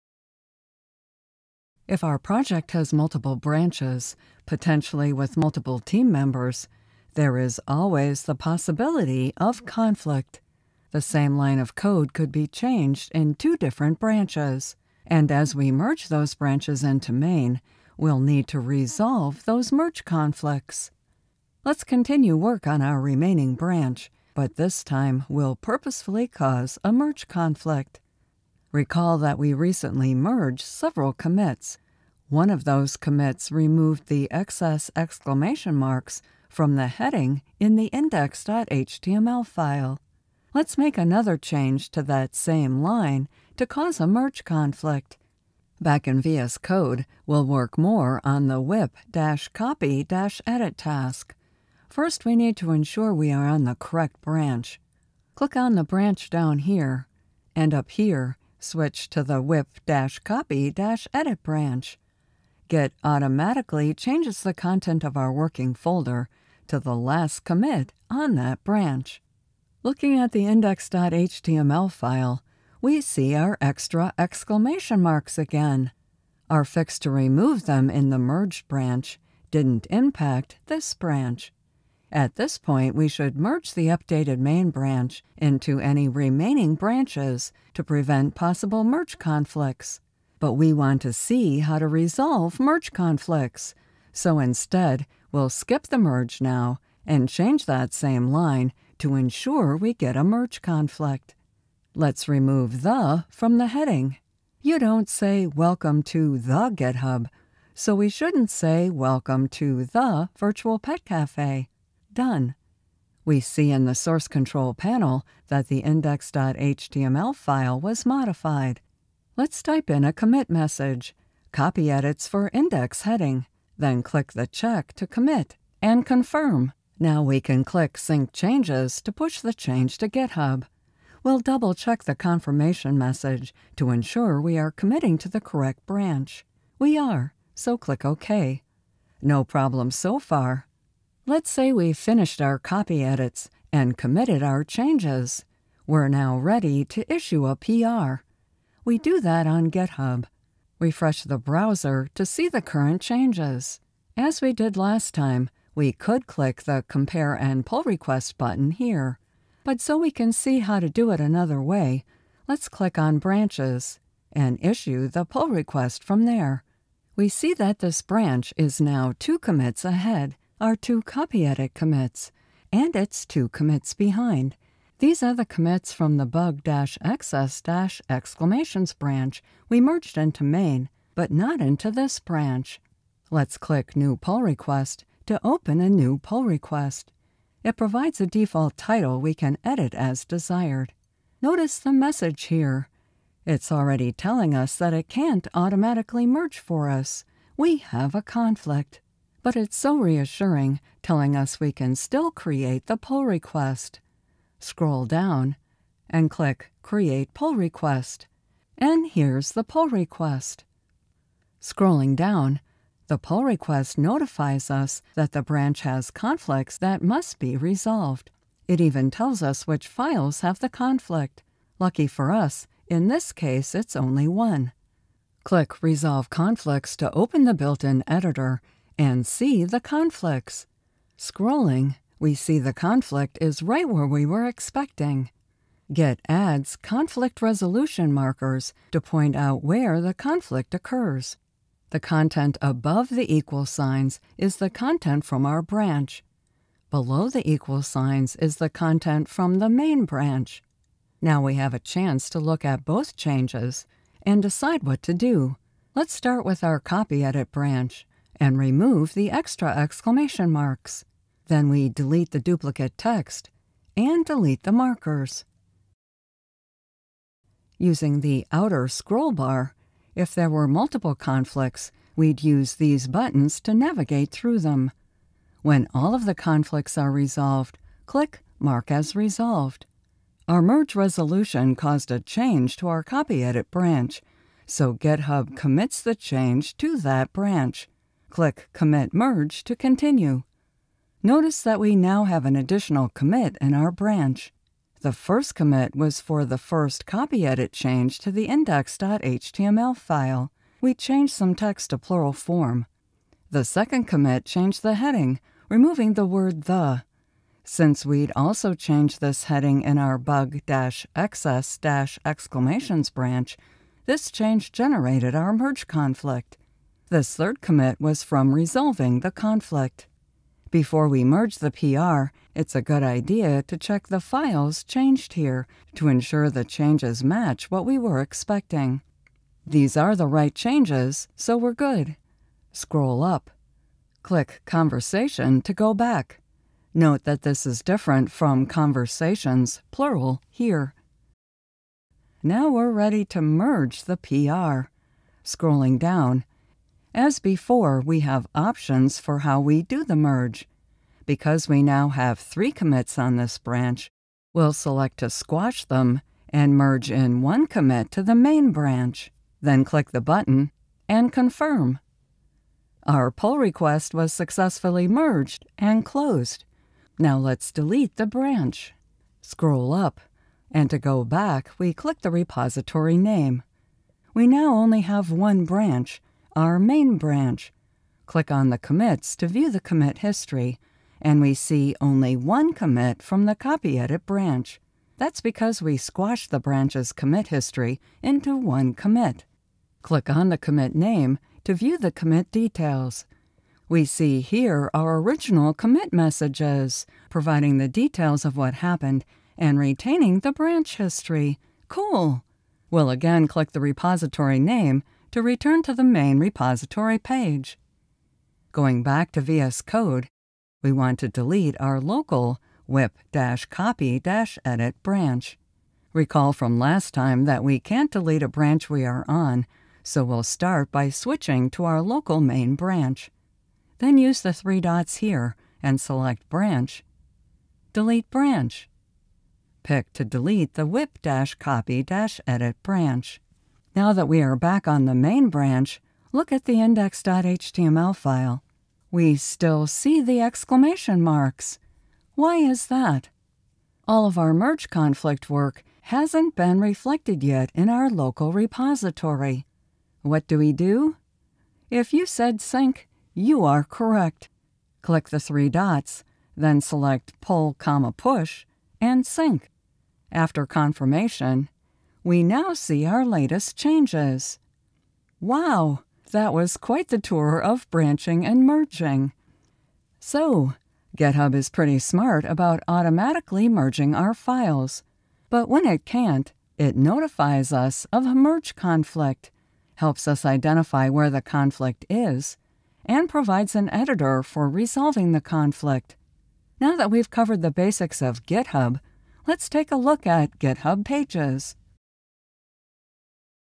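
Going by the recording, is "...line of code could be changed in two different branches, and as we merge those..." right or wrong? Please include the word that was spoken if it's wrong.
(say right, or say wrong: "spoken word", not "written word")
right.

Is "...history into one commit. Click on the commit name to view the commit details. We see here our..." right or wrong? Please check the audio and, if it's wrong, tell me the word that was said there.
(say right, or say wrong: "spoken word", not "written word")
right.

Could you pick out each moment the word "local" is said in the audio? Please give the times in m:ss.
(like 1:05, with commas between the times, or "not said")
6:52, 7:02, 7:28.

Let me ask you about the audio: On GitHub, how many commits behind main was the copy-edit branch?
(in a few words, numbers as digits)
2.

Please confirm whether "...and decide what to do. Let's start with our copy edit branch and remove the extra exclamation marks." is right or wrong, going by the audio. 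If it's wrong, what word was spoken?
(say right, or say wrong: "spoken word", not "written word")
right.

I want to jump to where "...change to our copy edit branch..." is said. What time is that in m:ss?
4:42.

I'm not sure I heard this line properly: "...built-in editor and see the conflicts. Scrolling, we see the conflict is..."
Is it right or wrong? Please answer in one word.
right.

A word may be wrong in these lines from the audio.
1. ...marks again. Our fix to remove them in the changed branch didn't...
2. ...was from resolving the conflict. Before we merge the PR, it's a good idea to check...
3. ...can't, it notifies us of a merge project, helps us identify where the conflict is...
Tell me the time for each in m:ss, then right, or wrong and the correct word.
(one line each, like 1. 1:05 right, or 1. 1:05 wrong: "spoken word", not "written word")
1. 1:15 wrong: "merged", not "changed"
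2. 5:17 right
3. 7:56 wrong: "conflict", not "project".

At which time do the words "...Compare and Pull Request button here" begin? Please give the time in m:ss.
2:36.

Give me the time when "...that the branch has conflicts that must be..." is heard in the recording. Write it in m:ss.
3:35.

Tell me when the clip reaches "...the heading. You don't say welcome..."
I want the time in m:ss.
1:43.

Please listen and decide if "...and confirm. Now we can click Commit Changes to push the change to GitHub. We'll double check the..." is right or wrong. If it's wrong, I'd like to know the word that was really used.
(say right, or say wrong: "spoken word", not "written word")
wrong: "Sync", not "Commit".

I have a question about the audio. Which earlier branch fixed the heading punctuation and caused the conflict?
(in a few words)
bug-excess-exclamations.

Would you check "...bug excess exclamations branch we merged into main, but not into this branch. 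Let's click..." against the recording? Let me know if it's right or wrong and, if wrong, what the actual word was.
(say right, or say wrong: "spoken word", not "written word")
right.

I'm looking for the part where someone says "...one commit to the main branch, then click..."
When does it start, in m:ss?
5:57.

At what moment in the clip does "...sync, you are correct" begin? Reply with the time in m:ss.
7:32.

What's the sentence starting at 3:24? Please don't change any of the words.
Scroll down and click Create Pull Request, and here's the pull request.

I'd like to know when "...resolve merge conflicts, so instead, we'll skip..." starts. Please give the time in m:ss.
1:31.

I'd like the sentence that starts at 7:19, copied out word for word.
We still see the exclamation marks.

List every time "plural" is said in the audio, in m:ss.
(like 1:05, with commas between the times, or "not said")
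5:01, 5:39.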